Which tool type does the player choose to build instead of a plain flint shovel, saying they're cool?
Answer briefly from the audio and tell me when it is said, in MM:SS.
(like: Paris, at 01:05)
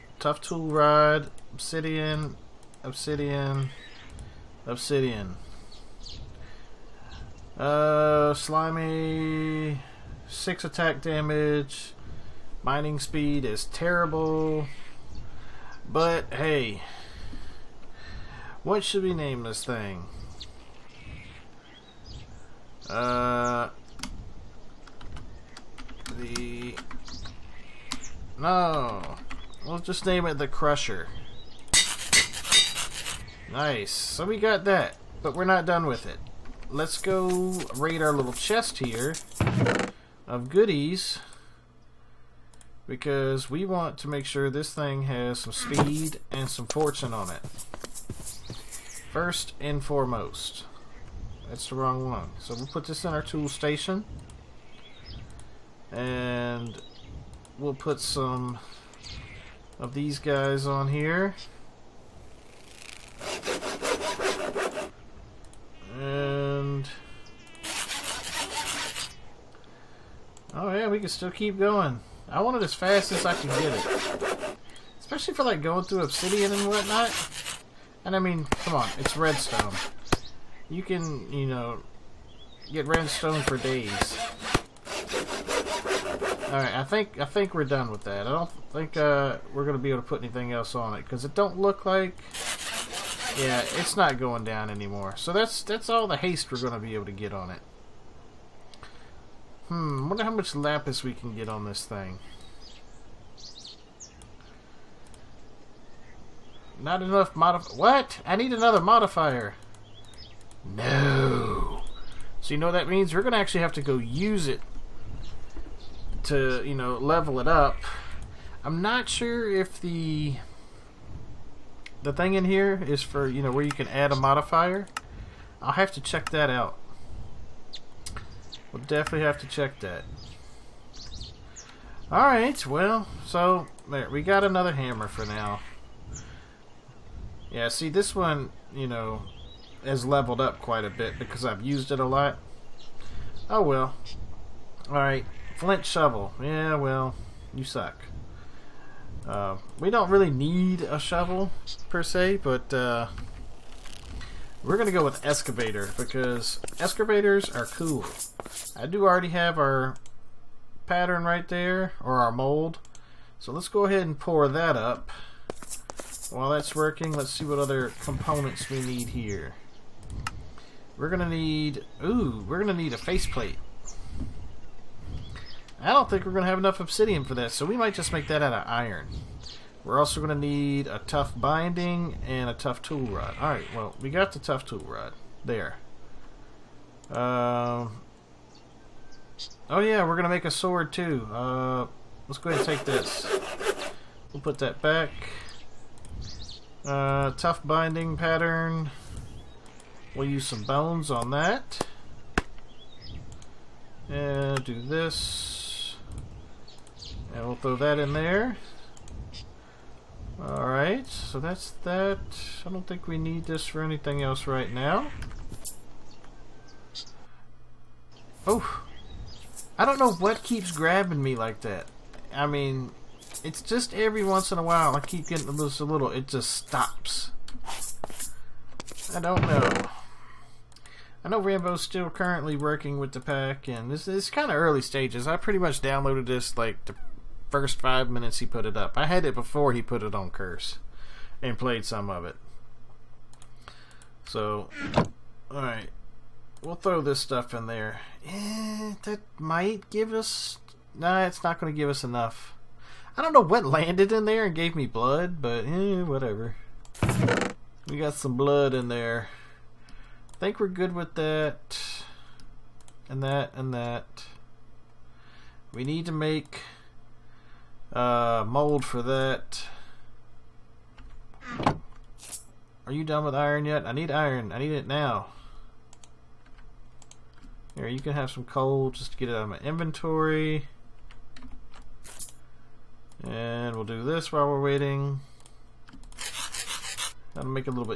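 Excavator, at 02:35.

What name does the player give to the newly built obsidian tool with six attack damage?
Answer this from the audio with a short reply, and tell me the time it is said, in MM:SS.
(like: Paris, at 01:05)
The Crusher, at 00:30.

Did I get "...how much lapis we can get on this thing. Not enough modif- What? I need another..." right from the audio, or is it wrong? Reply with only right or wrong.
right.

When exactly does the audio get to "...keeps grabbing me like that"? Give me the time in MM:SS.
03:40.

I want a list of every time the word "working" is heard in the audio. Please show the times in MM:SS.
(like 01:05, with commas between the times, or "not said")
02:46, 03:52.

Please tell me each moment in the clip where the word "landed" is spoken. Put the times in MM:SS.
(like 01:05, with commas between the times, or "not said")
04:13.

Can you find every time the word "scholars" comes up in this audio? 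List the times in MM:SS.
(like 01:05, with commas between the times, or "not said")
not said.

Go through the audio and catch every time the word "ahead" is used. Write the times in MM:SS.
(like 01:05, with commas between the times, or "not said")
02:43, 03:12.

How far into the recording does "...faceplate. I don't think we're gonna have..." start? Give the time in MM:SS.
02:52.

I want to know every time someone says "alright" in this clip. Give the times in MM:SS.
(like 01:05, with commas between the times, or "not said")
01:26, 02:12, 02:24, 03:03, 03:30, 04:05.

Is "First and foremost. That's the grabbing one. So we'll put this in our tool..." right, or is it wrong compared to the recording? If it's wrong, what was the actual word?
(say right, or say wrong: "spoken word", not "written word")
wrong: "wrong", not "grabbing".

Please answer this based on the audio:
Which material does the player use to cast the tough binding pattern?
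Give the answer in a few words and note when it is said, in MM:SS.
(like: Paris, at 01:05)
Bones, at 03:20.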